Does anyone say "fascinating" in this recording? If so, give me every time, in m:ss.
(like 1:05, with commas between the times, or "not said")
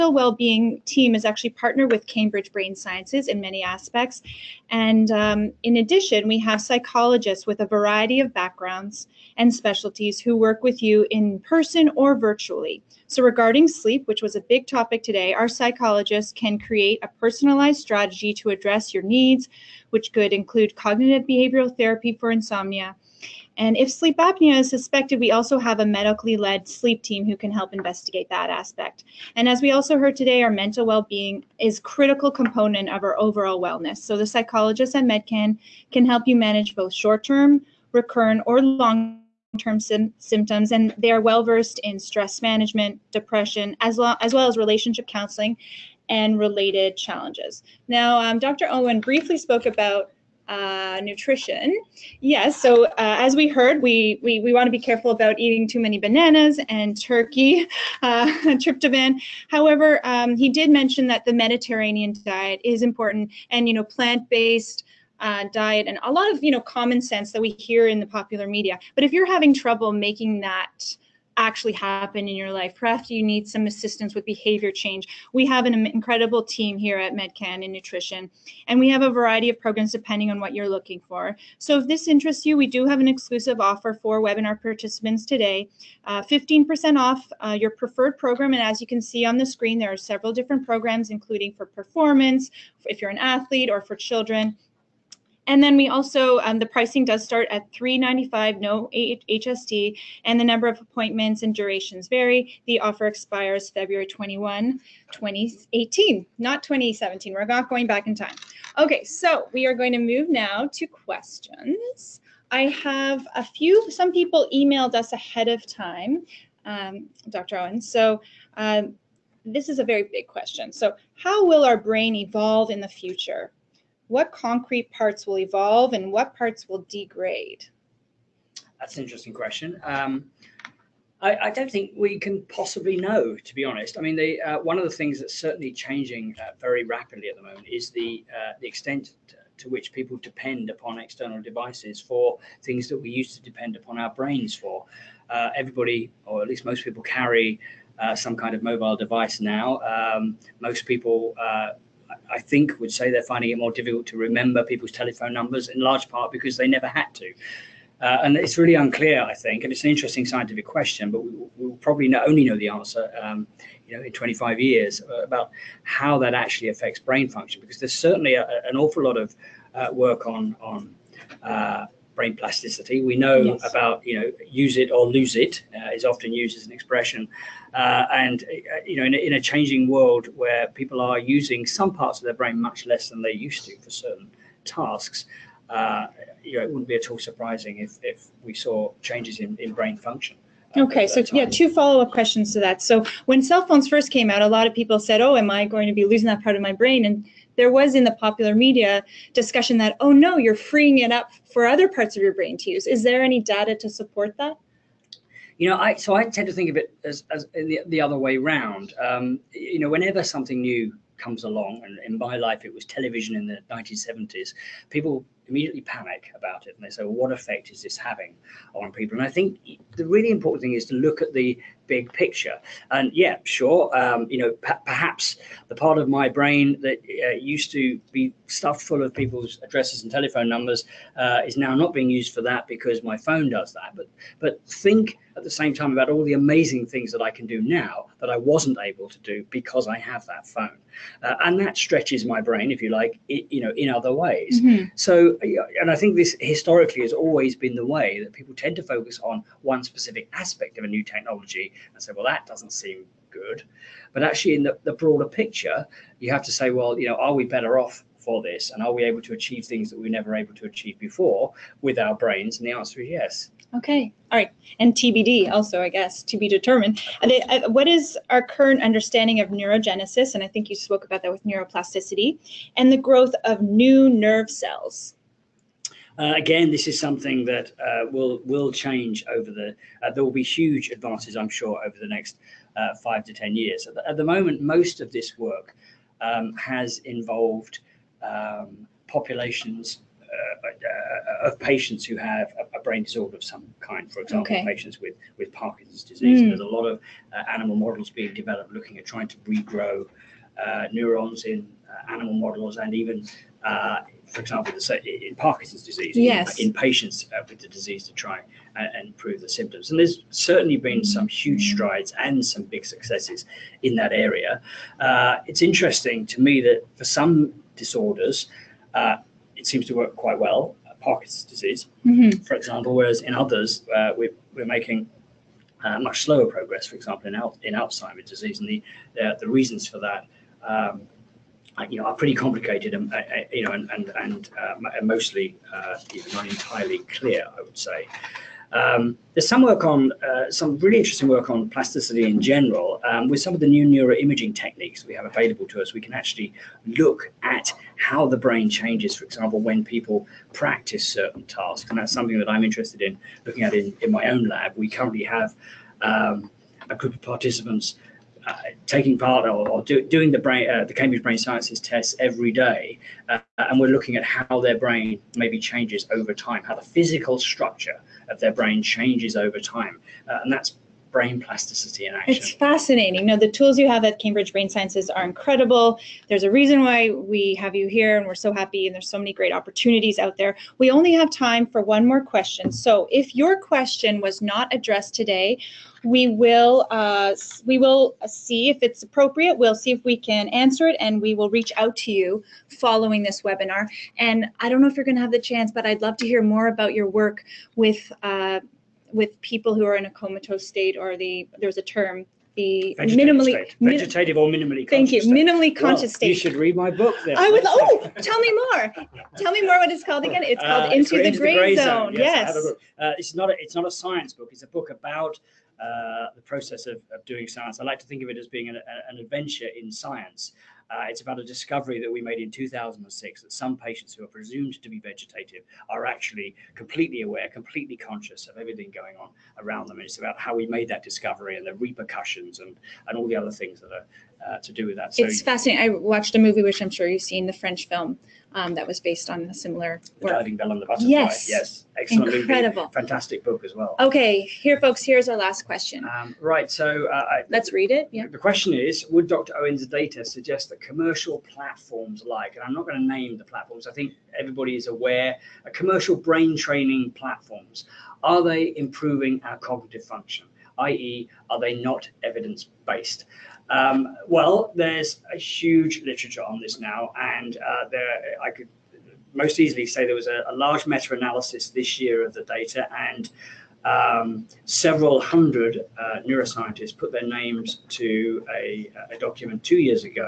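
6:12, 7:15.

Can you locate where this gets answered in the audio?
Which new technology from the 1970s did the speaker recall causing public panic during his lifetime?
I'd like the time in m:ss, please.
3:32.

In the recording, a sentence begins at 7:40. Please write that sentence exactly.
i.e., are they not evidence based?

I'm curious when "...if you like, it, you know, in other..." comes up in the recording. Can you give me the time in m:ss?
4:02.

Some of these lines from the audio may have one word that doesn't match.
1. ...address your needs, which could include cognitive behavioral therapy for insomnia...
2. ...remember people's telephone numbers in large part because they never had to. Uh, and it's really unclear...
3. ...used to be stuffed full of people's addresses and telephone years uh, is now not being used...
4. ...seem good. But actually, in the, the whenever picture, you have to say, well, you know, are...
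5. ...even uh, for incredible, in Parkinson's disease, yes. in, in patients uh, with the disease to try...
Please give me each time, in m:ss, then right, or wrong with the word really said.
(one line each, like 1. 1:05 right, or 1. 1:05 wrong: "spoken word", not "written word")
1. 0:18 right
2. 2:34 right
3. 3:47 wrong: "numbers", not "years"
4. 4:12 wrong: "broader", not "whenever"
5. 5:02 wrong: "example", not "incredible".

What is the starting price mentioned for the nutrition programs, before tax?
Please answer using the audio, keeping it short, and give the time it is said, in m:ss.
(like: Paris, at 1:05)
395, at 1:37.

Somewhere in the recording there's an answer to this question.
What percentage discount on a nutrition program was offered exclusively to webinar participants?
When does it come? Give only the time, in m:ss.
1:26.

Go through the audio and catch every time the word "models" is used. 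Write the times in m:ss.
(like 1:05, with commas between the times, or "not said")
4:57, 5:02.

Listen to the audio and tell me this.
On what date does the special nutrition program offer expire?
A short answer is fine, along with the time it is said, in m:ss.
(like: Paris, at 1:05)
February 21, 2018, at 1:43.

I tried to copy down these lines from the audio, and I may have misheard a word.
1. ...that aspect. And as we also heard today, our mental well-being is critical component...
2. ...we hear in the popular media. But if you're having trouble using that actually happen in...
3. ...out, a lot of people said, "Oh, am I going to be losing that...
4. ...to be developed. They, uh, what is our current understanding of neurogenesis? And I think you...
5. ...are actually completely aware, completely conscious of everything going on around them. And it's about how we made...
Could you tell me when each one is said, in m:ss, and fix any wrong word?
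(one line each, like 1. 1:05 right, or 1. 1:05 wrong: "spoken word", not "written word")
1. 0:28 right
2. 1:07 wrong: "making", not "using"
3. 3:14 right
4. 4:26 wrong: "determined", not "developed"
5. 7:05 right.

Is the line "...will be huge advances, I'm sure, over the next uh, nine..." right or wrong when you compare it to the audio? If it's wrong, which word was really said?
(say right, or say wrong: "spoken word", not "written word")
wrong: "five", not "nine".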